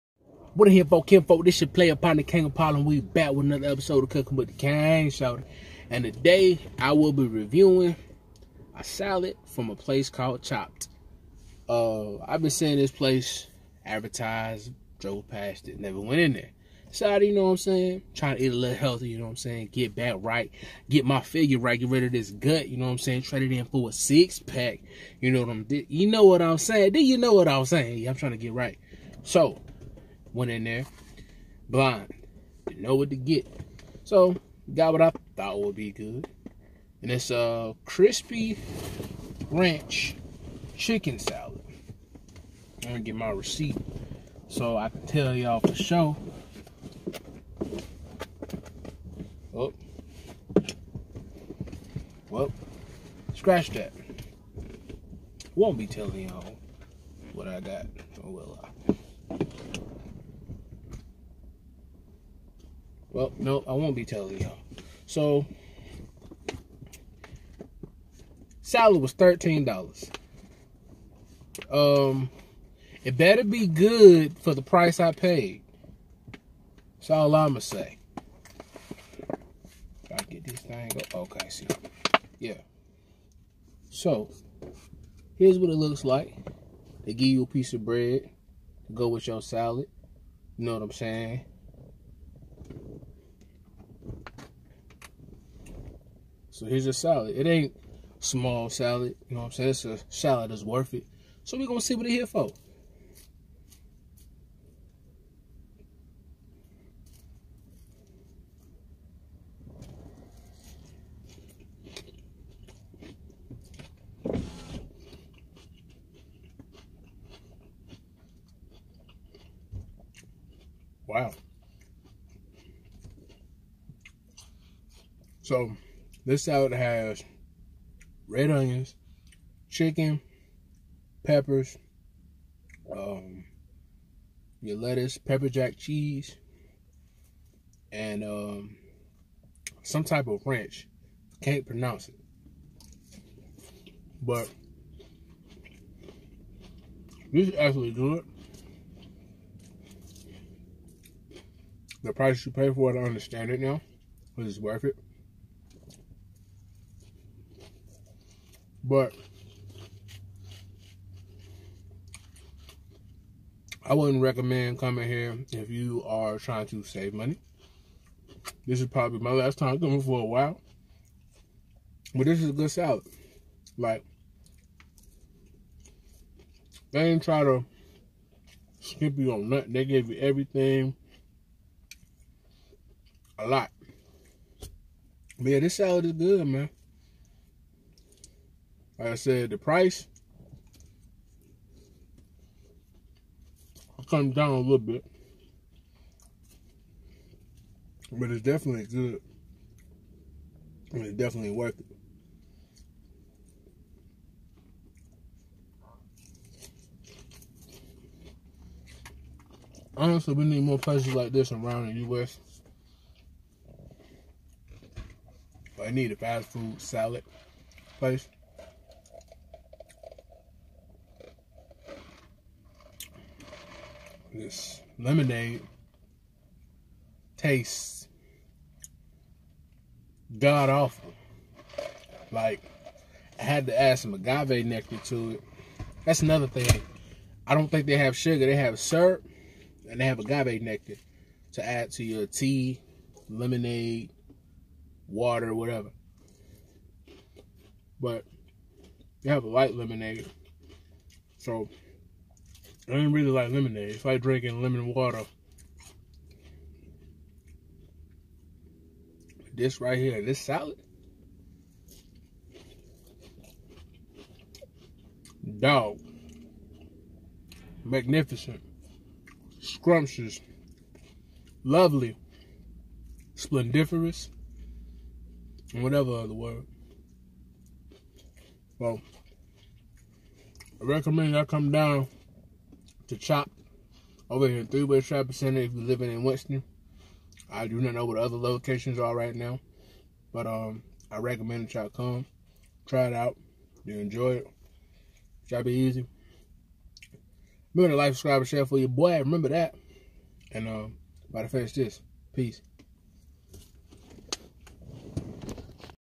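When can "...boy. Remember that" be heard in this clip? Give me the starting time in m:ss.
4:58.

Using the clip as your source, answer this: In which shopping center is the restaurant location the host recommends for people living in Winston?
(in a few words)
Thruway Shopping Center.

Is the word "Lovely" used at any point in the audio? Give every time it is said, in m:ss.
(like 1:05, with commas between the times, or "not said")
4:31.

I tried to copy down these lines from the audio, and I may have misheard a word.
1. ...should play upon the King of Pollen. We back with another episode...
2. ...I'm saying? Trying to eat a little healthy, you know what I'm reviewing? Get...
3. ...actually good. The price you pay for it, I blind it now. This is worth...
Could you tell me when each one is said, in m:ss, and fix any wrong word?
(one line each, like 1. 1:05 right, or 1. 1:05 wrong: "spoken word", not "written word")
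1. 0:01 right
2. 0:17 wrong: "saying", not "reviewing"
3. 2:27 wrong: "understand", not "blind".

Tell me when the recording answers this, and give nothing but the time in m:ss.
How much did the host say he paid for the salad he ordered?
1:09.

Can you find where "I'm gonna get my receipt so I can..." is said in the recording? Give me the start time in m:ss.
0:42.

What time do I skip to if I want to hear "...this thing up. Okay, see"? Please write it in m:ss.
1:20.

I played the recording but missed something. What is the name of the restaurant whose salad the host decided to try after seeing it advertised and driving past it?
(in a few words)
Chopt.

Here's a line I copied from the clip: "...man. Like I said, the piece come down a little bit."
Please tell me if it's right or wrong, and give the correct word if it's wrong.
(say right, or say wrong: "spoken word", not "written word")
wrong: "price", not "piece".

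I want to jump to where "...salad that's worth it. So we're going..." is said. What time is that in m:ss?
1:40.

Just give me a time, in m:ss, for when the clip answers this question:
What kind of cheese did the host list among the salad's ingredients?
2:15.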